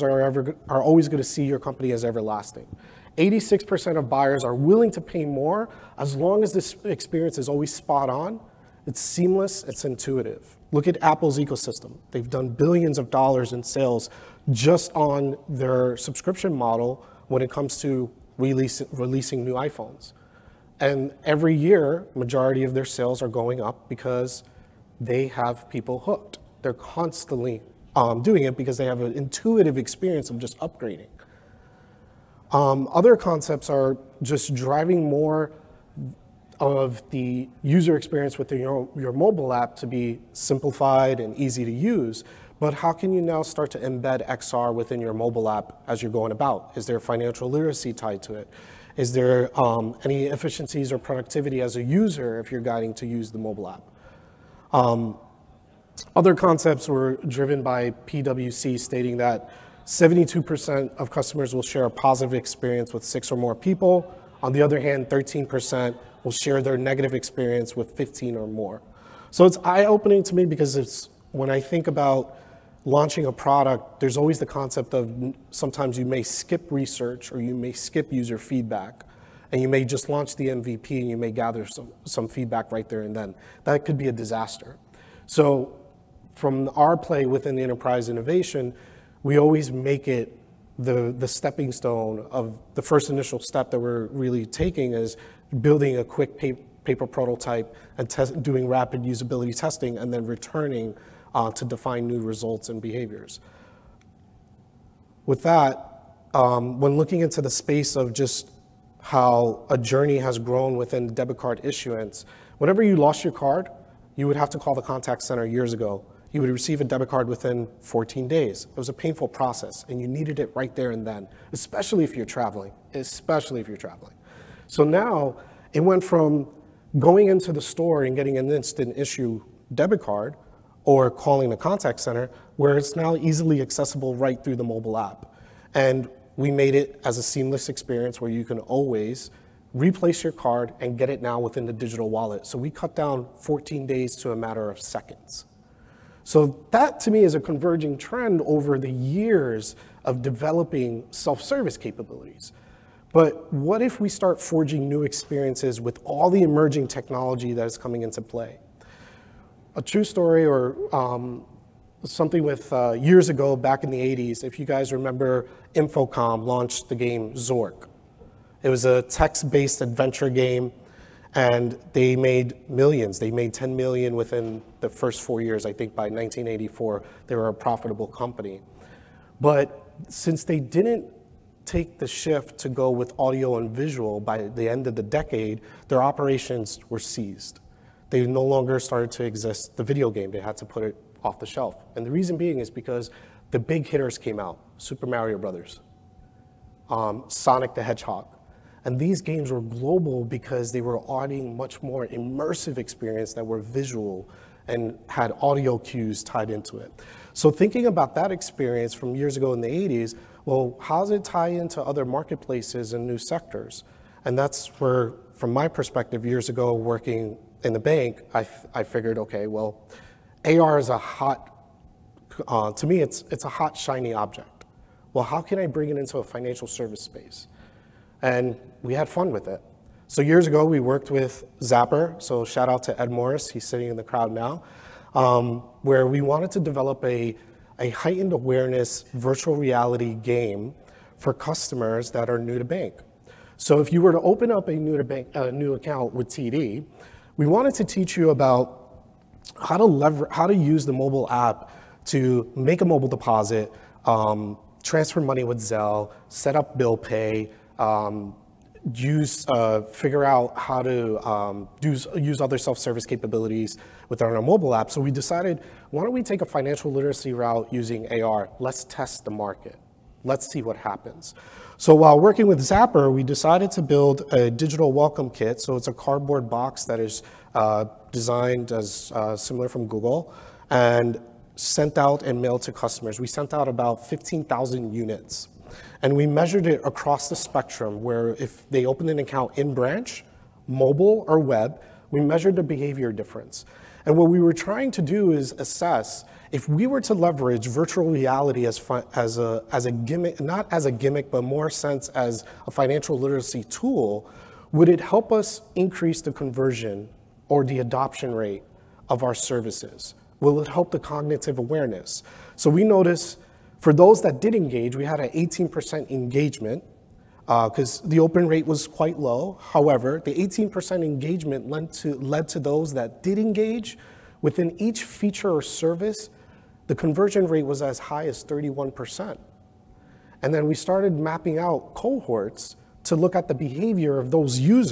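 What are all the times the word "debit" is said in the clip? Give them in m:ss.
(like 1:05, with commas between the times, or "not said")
1:51, 1:56, 2:09.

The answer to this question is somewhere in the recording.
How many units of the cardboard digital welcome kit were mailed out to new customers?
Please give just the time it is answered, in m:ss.
4:44.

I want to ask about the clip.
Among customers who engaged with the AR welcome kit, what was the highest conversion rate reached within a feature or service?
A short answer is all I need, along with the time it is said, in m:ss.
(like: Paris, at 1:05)
31%, at 5:28.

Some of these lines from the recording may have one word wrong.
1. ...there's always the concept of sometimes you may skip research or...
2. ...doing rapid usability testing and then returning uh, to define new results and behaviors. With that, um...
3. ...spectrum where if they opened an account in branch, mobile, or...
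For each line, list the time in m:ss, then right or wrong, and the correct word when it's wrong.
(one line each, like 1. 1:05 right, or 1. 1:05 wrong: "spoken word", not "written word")
1. 1:14 right
2. 1:38 right
3. 4:47 right.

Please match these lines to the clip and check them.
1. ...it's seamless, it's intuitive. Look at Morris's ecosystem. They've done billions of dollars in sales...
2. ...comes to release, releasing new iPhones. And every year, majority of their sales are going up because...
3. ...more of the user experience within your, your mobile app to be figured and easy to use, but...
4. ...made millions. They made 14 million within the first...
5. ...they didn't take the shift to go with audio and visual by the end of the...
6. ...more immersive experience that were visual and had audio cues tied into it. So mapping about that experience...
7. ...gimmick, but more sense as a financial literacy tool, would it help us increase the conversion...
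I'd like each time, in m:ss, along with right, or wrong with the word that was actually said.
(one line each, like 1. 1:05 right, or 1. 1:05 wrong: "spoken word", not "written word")
1. 0:08 wrong: "Apple", not "Morris"
2. 0:17 right
3. 0:35 wrong: "simplified", not "figured"
4. 2:52 wrong: "10", not "14"
5. 3:00 right
6. 3:21 wrong: "thinking", not "mapping"
7. 5:00 right.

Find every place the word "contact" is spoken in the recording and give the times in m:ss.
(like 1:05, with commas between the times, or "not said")
1:54, 2:11.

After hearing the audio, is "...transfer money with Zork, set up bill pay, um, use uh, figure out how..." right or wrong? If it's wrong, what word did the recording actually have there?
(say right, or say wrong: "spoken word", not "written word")
wrong: "Zelle", not "Zork".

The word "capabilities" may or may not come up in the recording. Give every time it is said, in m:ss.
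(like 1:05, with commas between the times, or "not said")
2:31, 4:23.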